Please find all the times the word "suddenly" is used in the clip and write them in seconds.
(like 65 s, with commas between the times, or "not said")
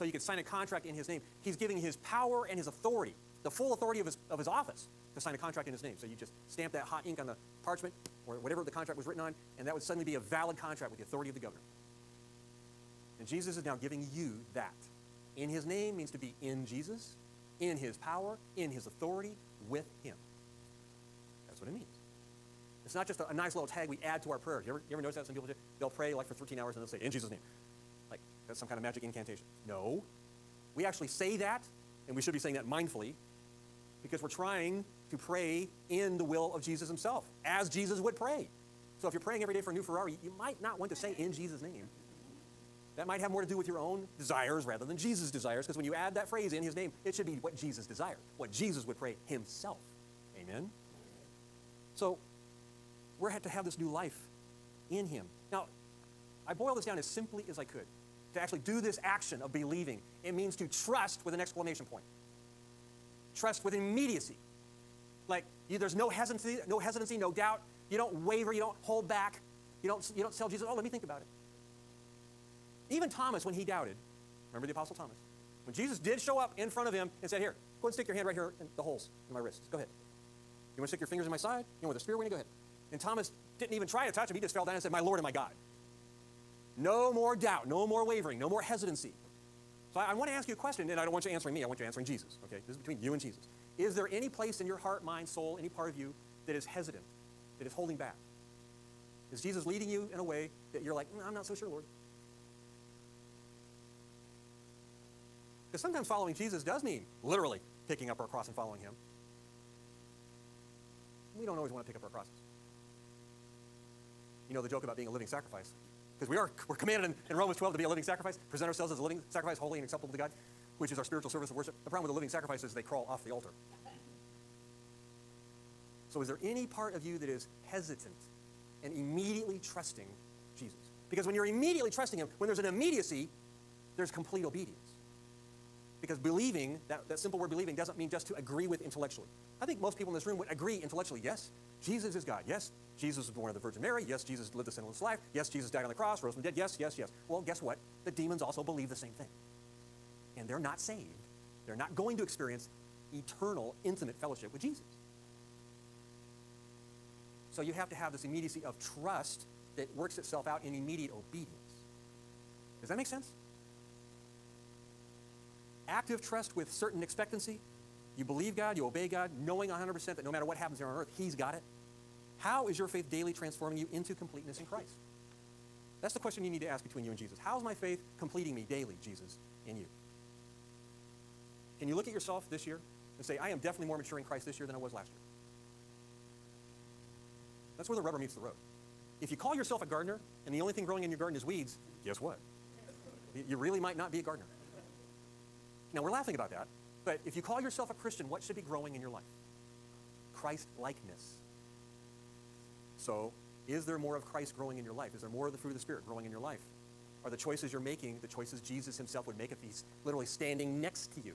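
9 s.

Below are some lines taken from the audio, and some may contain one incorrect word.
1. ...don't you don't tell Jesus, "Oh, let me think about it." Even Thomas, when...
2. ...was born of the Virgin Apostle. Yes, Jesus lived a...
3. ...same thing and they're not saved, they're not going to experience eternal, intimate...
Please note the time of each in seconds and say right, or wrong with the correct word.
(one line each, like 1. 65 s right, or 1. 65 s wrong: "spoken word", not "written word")
1. 69 s right
2. 143 s wrong: "Mary", not "Apostle"
3. 148 s right.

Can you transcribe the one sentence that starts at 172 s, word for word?
How is your faith daily transforming you into completeness in Christ?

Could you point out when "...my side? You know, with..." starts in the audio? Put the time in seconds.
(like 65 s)
81 s.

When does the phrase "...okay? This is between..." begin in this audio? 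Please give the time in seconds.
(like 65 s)
92 s.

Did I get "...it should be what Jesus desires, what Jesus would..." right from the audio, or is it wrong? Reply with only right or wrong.
right.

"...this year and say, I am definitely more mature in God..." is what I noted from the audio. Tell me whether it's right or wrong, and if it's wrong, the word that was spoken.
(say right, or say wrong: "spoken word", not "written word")
wrong: "Christ", not "God".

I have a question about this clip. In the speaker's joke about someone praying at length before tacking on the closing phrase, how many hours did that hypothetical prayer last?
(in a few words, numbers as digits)
13.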